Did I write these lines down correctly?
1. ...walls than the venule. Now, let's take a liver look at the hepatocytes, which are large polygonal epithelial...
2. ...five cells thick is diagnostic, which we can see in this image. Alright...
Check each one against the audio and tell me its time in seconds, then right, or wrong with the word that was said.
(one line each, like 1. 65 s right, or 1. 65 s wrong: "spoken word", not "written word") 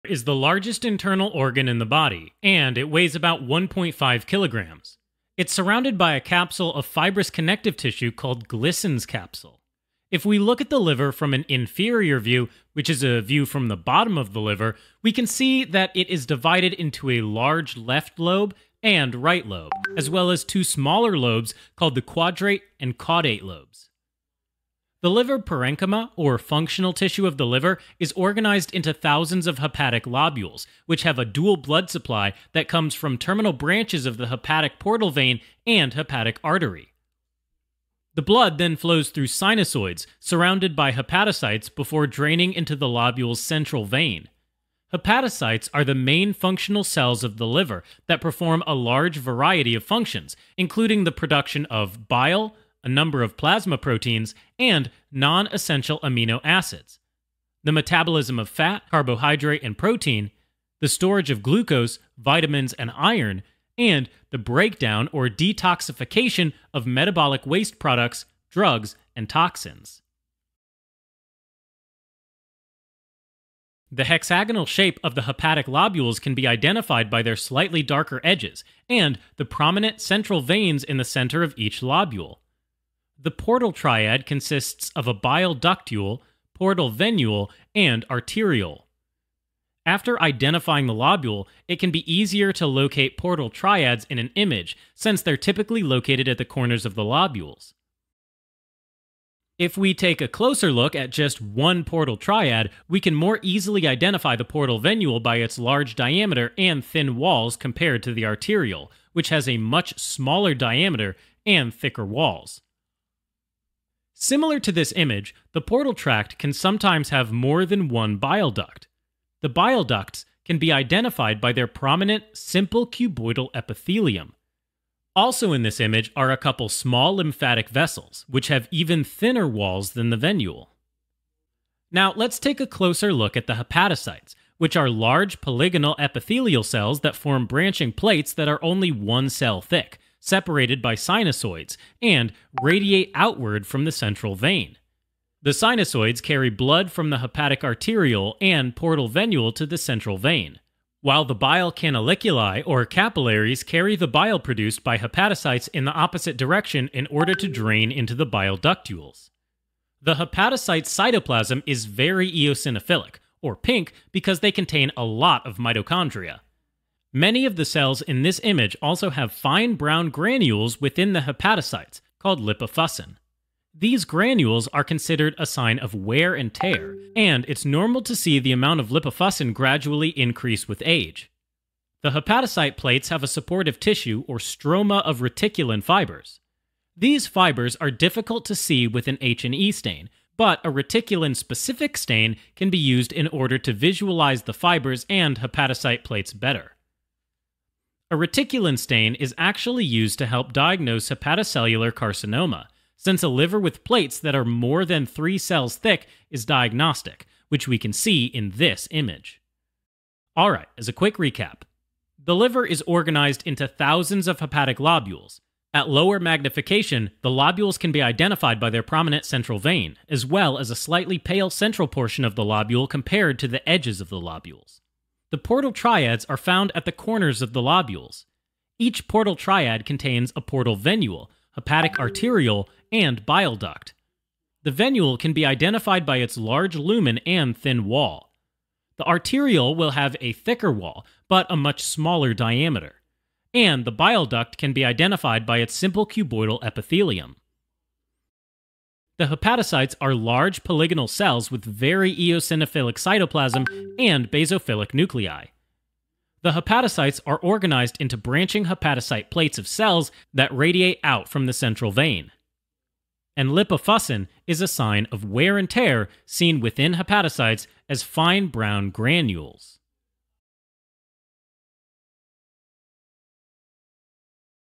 1. 129 s wrong: "closer", not "liver"
2. 205 s wrong: "three", not "five".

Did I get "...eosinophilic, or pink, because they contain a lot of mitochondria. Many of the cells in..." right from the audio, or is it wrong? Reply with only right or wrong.
right.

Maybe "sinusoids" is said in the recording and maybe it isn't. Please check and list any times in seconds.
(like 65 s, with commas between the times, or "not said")
39 s, 140 s, 145 s.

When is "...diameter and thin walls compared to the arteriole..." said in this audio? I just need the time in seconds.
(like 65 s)
105 s.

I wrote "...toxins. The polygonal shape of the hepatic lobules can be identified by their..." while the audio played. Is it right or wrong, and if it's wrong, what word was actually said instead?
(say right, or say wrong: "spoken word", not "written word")
wrong: "hexagonal", not "polygonal".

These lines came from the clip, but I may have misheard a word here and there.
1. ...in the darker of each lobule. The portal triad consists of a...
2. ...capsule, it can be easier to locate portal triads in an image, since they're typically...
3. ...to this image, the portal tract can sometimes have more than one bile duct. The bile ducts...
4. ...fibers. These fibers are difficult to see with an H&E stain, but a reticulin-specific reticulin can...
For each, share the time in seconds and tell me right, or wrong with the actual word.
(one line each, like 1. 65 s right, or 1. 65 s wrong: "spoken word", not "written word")
1. 80 s wrong: "center", not "darker"
2. 90 s wrong: "lobule", not "capsule"
3. 114 s right
4. 185 s wrong: "stain", not "reticulin".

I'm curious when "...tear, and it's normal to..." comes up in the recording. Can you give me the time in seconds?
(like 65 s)
176 s.